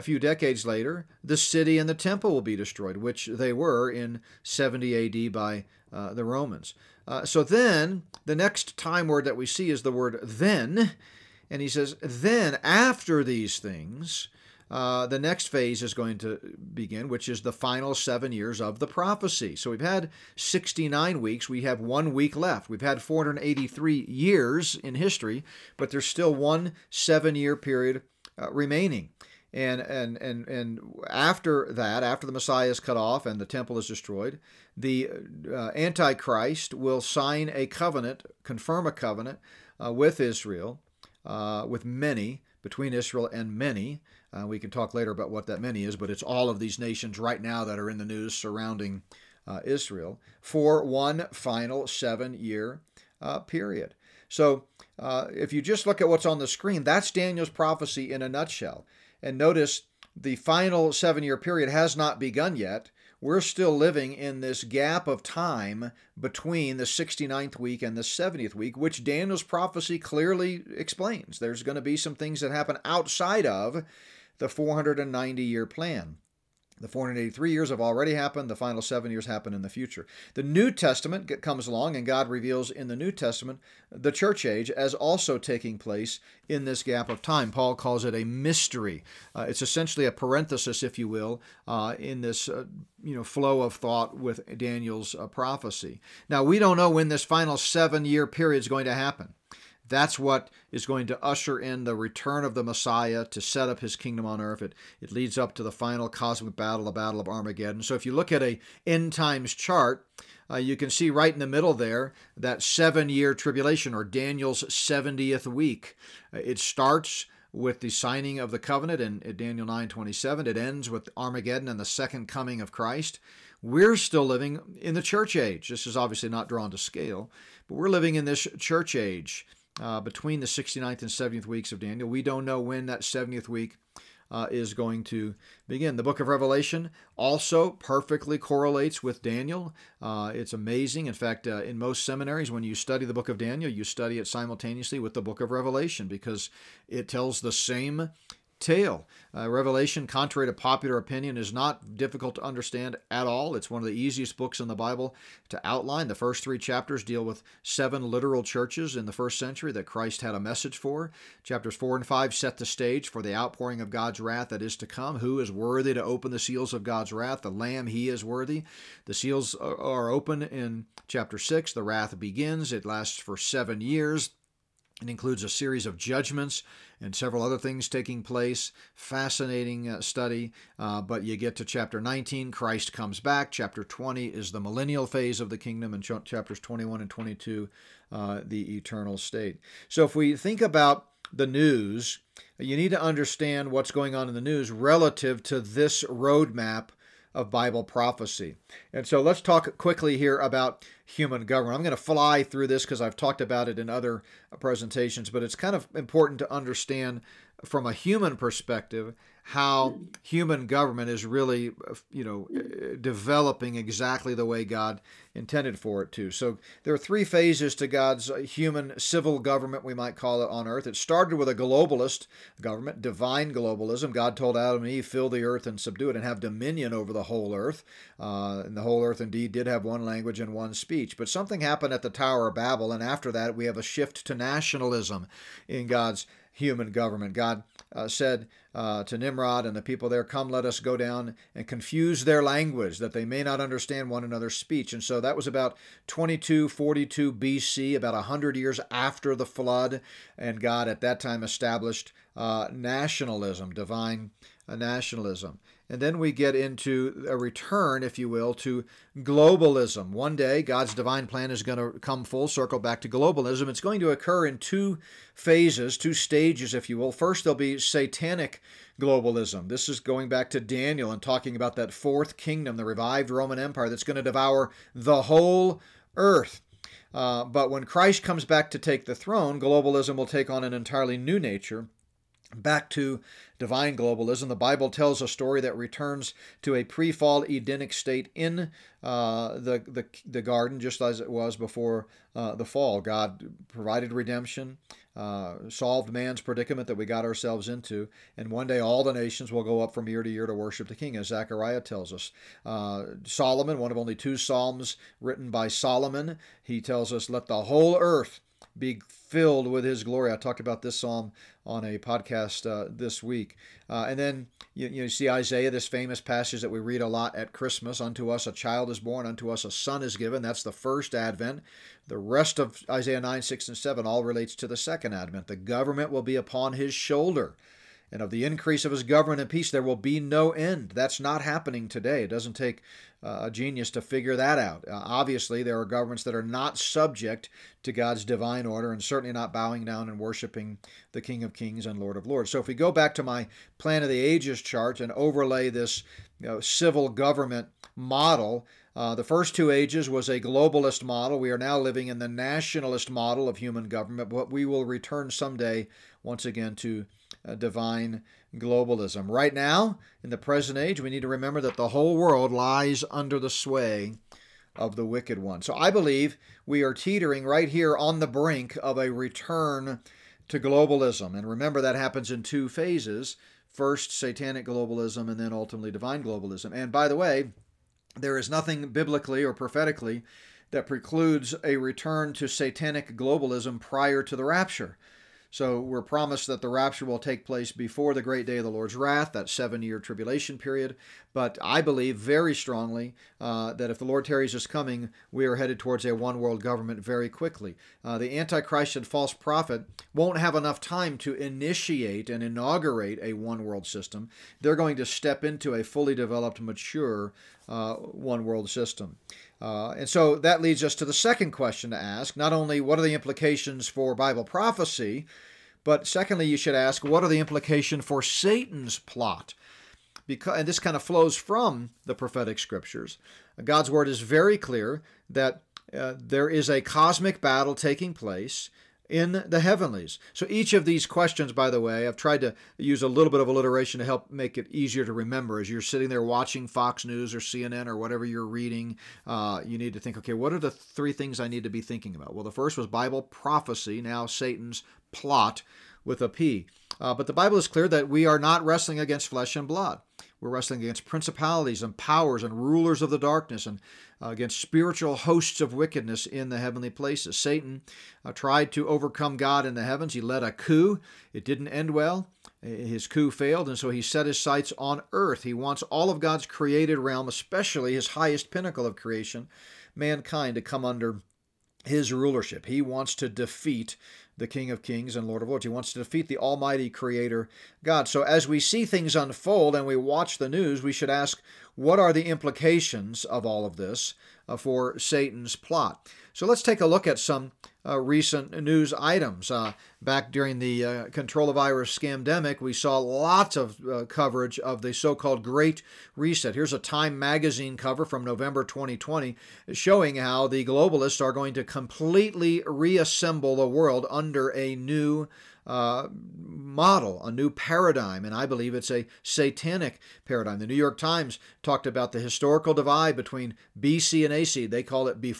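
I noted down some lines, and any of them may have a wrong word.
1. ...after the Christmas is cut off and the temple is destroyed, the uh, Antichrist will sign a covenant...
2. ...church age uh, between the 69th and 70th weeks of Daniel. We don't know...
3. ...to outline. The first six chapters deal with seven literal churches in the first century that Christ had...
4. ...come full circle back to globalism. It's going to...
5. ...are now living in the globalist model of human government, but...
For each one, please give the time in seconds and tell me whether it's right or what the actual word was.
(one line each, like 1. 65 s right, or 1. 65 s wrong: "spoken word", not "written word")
1. 32 s wrong: "Messiah", not "Christmas"
2. 128 s right
3. 155 s wrong: "three", not "six"
4. 261 s right
5. 351 s wrong: "nationalist", not "globalist".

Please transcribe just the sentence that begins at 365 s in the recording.
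So I believe we are teetering right here on the brink of a return to globalism.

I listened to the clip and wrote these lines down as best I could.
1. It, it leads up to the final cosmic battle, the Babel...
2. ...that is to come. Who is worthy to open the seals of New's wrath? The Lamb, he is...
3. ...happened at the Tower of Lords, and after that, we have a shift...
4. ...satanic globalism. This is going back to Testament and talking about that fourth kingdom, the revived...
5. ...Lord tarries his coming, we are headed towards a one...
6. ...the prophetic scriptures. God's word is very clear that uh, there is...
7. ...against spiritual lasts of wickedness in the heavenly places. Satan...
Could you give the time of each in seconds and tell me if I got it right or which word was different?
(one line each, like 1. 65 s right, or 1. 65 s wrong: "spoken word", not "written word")
1. 104 s wrong: "Battle", not "Babel"
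2. 164 s wrong: "God", not "New"
3. 231 s wrong: "Babel", not "Lords"
4. 267 s wrong: "Daniel", not "Testament"
5. 394 s right
6. 422 s right
7. 454 s wrong: "hosts", not "lasts".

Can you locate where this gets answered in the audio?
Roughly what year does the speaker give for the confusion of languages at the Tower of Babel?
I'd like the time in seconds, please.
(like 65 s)
246 s.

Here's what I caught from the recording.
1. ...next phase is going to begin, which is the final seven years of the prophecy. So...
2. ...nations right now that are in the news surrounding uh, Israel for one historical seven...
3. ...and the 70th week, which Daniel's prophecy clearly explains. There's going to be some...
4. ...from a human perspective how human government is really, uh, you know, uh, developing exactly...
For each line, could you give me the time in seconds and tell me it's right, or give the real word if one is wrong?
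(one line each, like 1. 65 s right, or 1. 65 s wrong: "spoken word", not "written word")
1. 15 s right
2. 46 s wrong: "final", not "historical"
3. 67 s right
4. 207 s right.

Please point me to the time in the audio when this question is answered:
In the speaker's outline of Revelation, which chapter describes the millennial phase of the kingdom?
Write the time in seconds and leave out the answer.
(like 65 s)
183 s.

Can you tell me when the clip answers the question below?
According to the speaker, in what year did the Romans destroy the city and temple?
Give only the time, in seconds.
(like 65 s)
4 s.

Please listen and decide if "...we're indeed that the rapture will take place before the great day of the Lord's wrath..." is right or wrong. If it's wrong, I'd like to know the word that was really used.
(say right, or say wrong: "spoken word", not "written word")
wrong: "promised", not "indeed".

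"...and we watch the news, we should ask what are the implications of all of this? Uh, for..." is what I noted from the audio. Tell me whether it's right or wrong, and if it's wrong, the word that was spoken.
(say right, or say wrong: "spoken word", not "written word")
right.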